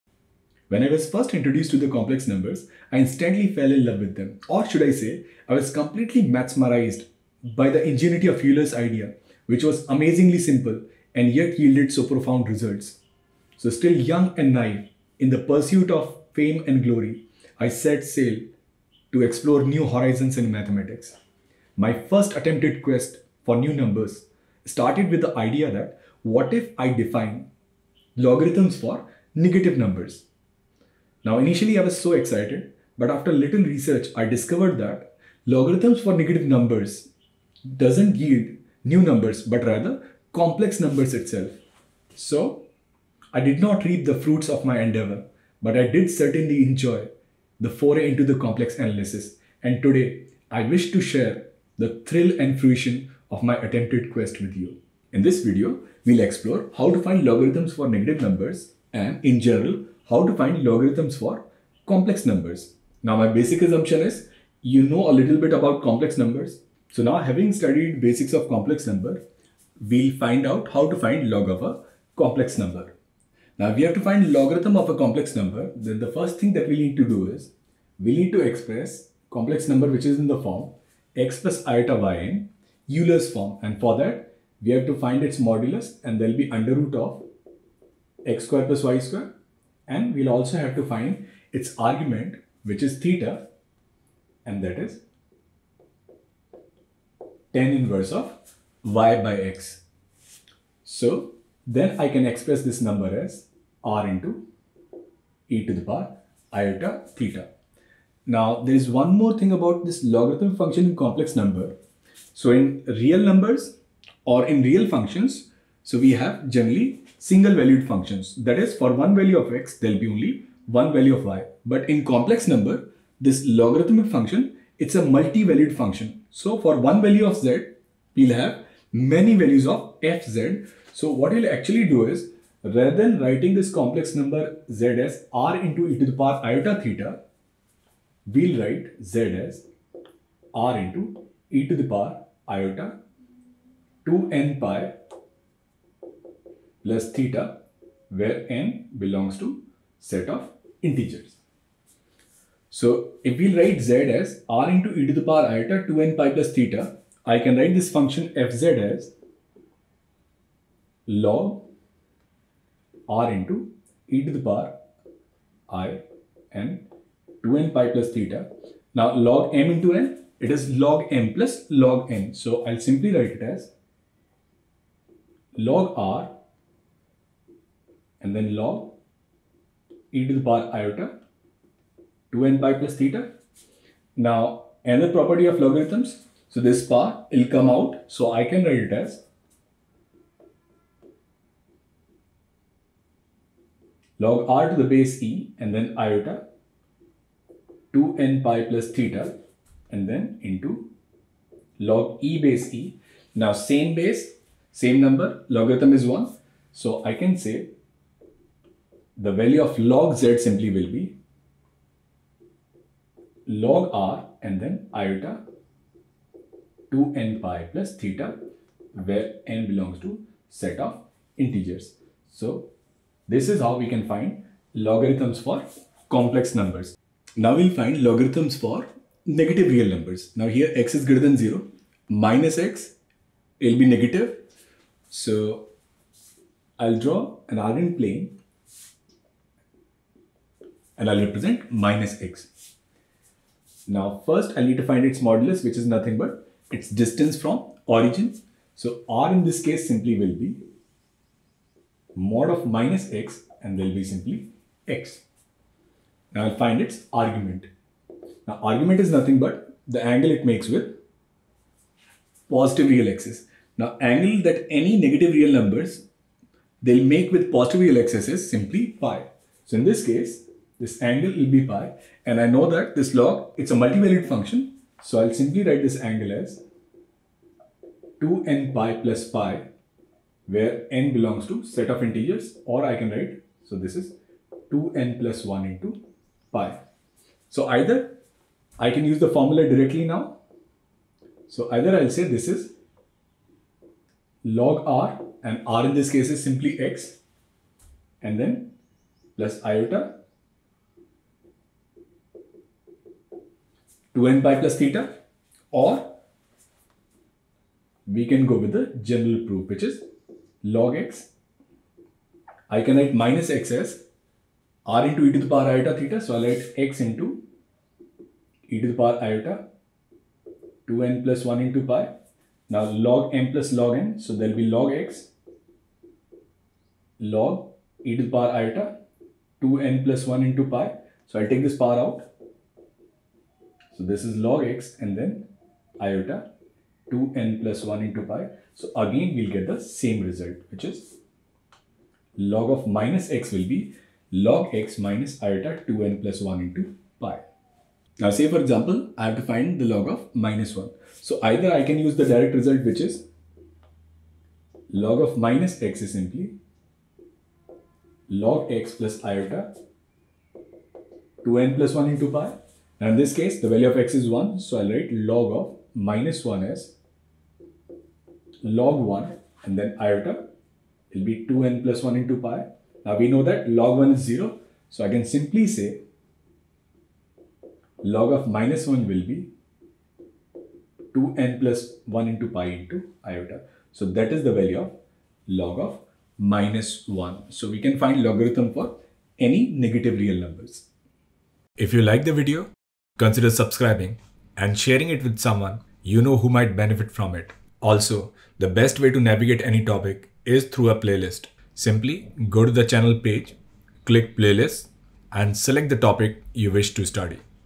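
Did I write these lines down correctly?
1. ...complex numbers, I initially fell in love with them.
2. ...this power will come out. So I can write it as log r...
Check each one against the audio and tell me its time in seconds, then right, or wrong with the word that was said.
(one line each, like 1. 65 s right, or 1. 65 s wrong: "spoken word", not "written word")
1. 1 s wrong: "instantly", not "initially"
2. 186 s right.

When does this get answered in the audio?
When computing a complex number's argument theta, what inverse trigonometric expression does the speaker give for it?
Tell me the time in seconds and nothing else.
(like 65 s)
97 s.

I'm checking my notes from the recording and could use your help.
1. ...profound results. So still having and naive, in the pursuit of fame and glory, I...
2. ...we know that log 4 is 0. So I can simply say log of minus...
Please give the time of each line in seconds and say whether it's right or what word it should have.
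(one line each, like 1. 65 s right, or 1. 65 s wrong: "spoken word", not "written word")
1. 12 s wrong: "young", not "having"
2. 373 s wrong: "1", not "4".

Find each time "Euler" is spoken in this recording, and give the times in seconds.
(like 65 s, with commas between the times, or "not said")
8 s, 82 s.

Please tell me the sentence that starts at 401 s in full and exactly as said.
Simply go to the channel page, click playlist, and select the topic you wish to study.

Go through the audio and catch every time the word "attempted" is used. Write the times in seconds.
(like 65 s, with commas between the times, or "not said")
22 s, 53 s.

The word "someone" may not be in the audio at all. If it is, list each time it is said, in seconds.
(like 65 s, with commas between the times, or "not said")
395 s.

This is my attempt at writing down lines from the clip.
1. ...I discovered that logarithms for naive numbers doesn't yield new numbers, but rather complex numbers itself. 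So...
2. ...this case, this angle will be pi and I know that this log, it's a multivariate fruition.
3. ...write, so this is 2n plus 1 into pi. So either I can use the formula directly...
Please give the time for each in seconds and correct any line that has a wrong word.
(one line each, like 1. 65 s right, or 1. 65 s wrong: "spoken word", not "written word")
1. 34 s wrong: "negative", not "naive"
2. 269 s wrong: "function", not "fruition"
3. 283 s right.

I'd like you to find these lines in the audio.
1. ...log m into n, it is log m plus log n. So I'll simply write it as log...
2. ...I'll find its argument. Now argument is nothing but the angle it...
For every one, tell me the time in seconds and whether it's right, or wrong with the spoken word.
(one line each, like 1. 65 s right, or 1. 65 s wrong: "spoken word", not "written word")
1. 169 s right
2. 256 s right.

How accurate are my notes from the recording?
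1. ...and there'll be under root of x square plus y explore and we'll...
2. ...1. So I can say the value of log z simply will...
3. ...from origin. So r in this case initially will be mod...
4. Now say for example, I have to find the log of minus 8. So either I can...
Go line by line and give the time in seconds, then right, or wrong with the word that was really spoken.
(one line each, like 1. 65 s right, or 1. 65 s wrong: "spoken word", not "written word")
1. 86 s wrong: "square", not "explore"
2. 206 s right
3. 247 s wrong: "simply", not "initially"
4. 348 s wrong: "1", not "8".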